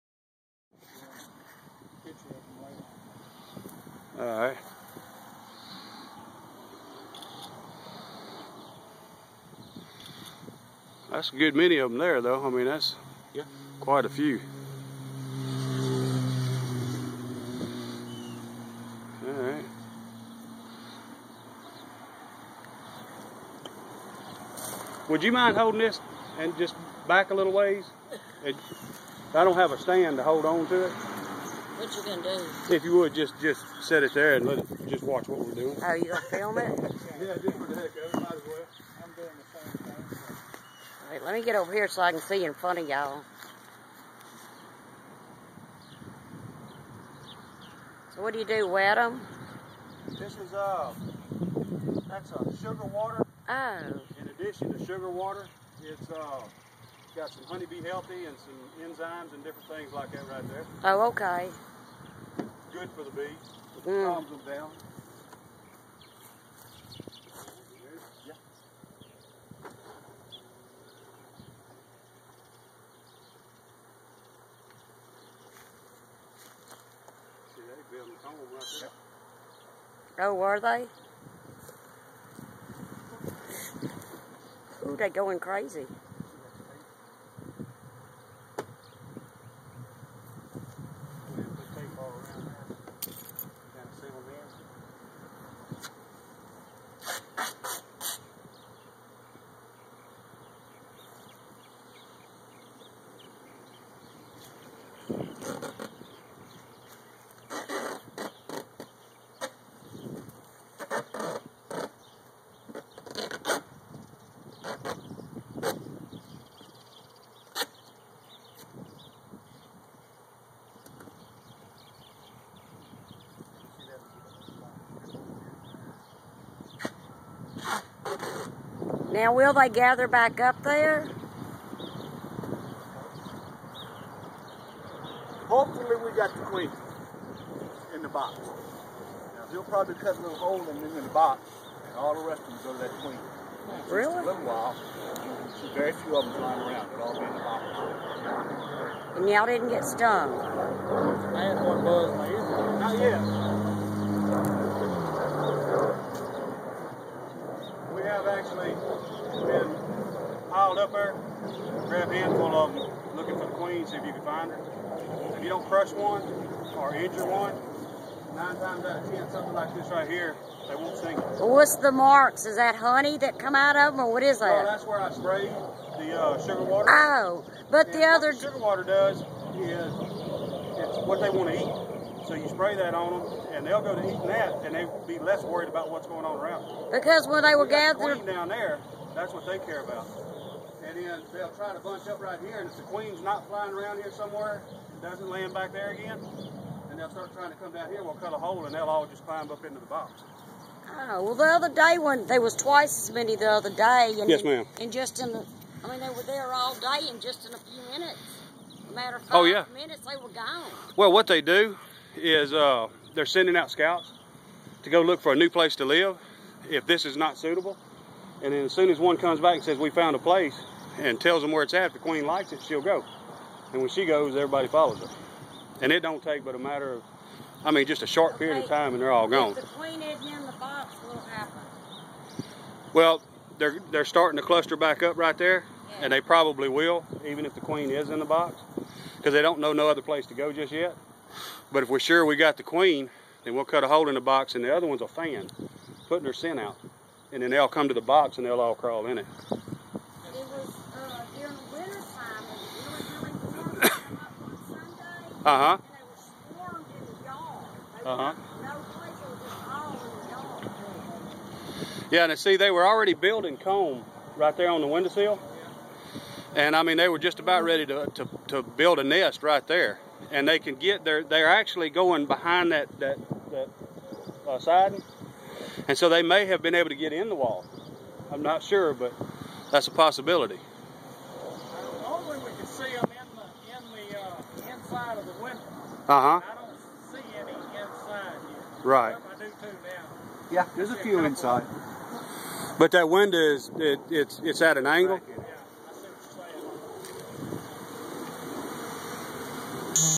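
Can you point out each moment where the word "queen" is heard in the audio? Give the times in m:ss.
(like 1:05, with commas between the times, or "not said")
2:16, 2:23, 2:43, 3:12, 3:41, 3:49, 3:57, 4:02.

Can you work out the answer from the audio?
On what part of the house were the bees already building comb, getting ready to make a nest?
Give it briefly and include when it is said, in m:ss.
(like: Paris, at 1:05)
the windowsill, at 4:24.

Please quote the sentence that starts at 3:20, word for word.
Oh, well, the other day when there was twice as many the other day.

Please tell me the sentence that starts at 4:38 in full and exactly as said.
I'm not sure, but that's a possibility.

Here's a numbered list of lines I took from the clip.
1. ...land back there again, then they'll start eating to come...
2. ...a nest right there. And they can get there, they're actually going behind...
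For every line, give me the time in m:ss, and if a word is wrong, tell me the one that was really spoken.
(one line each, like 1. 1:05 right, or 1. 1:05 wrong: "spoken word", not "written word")
1. 3:15 wrong: "trying", not "eating"
2. 4:28 right.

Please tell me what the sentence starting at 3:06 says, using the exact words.
Because when they were we gathered...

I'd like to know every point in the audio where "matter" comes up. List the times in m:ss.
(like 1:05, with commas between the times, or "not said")
3:28, 3:46.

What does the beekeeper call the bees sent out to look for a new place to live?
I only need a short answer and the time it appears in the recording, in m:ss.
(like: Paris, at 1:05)
scouts, at 3:33.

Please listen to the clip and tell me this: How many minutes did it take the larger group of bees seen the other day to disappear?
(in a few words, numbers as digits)
5.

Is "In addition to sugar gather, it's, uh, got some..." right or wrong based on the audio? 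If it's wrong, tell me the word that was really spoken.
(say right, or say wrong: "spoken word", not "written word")
wrong: "water", not "gather".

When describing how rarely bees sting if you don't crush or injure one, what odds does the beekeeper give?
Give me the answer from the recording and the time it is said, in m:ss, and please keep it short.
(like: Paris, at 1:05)
9 times out of 10, at 2:48.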